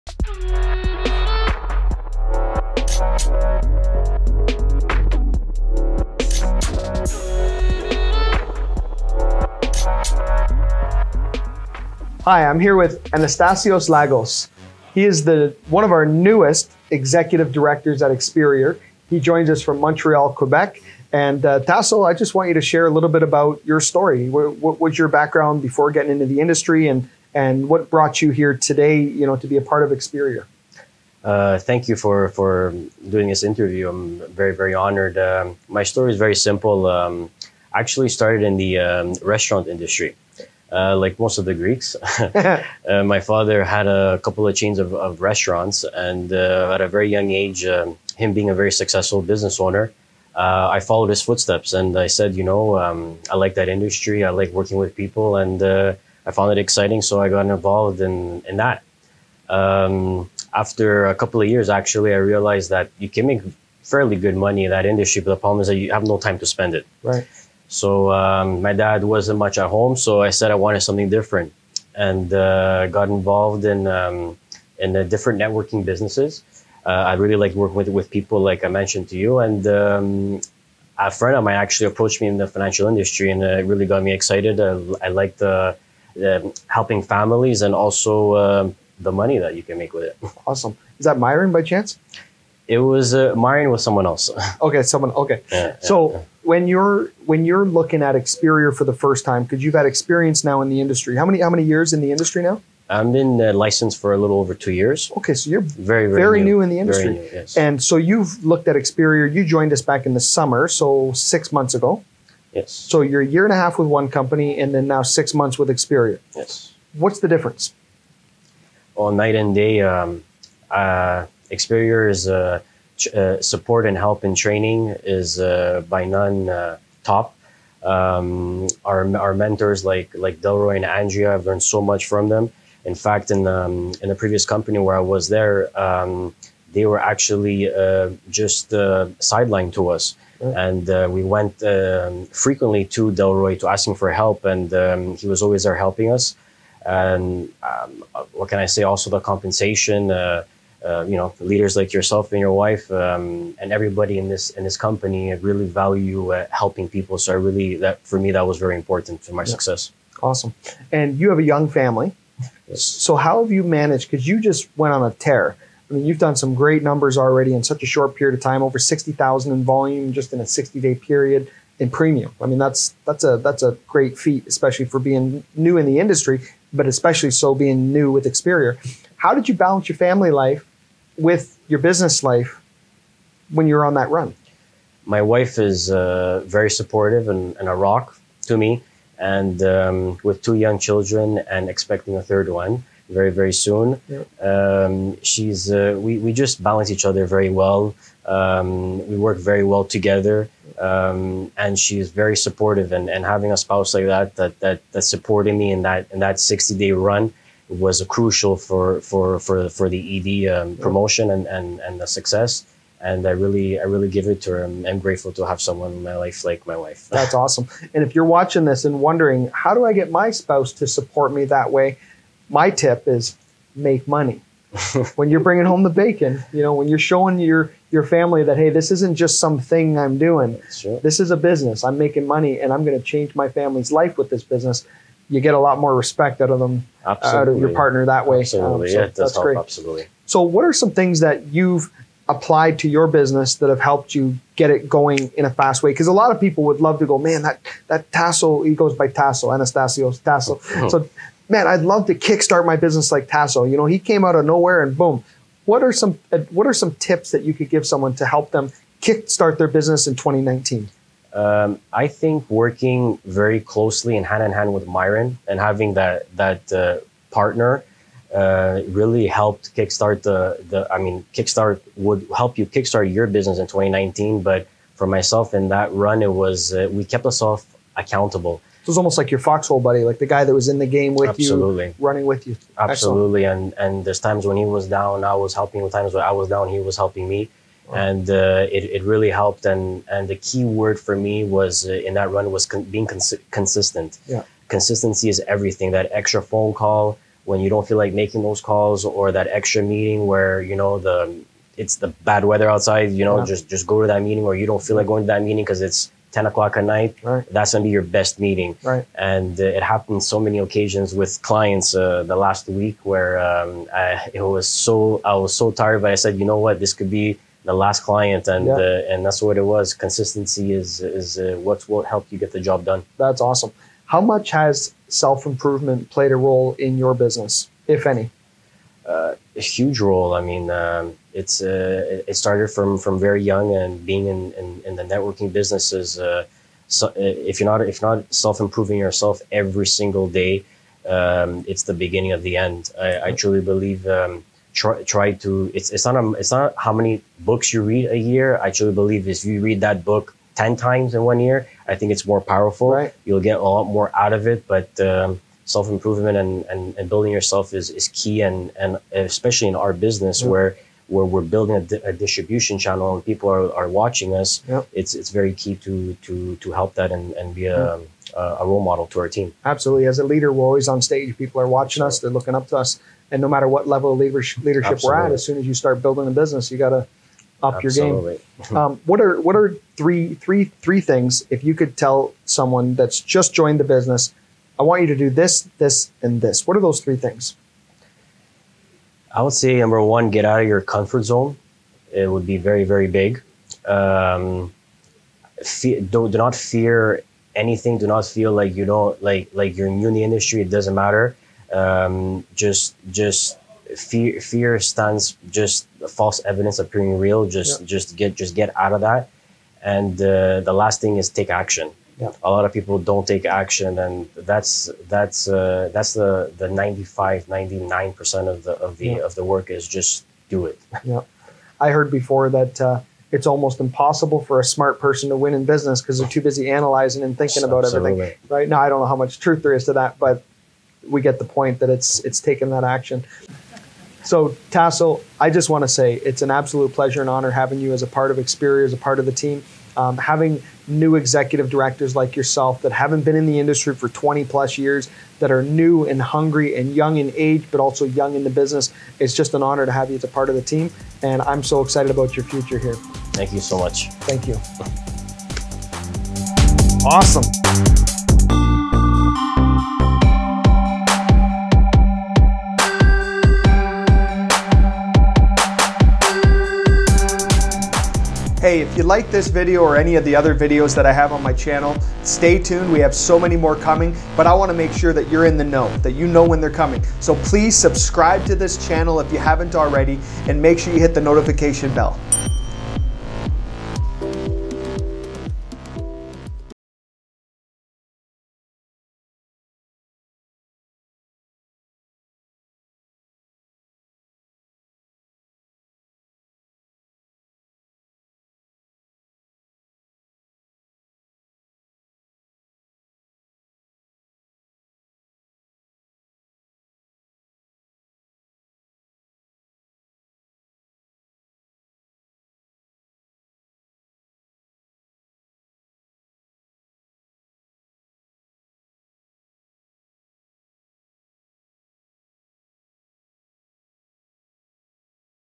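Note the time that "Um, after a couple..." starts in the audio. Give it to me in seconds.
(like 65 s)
59 s.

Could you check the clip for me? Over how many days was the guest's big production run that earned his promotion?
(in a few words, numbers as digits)
60.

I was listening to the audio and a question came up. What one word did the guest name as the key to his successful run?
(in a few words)
Consistent.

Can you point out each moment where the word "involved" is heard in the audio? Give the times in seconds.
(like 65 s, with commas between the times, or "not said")
57 s, 73 s.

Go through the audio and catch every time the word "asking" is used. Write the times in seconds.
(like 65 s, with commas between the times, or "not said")
143 s.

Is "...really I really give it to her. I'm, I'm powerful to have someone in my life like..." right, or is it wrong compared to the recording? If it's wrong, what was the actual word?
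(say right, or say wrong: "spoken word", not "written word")
wrong: "grateful", not "powerful".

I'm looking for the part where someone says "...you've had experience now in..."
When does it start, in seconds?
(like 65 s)
99 s.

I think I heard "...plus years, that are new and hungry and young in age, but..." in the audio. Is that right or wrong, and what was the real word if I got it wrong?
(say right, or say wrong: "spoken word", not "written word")
right.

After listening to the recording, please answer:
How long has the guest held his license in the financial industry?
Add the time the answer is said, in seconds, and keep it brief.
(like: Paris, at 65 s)
A little over two years, at 104 s.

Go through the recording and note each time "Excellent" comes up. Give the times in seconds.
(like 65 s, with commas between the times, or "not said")
283 s.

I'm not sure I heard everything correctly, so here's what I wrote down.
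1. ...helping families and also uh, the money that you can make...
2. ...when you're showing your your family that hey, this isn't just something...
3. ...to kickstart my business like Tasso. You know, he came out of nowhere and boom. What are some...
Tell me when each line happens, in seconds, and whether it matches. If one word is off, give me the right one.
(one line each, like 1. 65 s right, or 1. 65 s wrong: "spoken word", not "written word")
1. 86 s right
2. 226 s right
3. 252 s right.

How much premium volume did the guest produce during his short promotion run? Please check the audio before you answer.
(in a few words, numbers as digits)
Over 60,000.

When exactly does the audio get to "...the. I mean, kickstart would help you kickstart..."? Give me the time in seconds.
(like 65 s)
270 s.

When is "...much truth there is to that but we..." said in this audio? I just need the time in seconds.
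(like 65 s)
429 s.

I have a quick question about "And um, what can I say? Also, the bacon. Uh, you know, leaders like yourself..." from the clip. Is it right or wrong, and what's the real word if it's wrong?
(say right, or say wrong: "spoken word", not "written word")
wrong: "compensation", not "bacon".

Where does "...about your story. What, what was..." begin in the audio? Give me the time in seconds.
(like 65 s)
23 s.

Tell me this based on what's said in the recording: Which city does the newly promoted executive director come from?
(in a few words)
Montreal.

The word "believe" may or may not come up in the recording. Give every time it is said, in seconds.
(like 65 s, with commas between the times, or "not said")
343 s, 348 s.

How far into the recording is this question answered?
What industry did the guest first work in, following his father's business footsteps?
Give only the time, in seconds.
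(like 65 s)
39 s.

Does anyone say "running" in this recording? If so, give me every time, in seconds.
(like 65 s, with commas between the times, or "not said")
281 s.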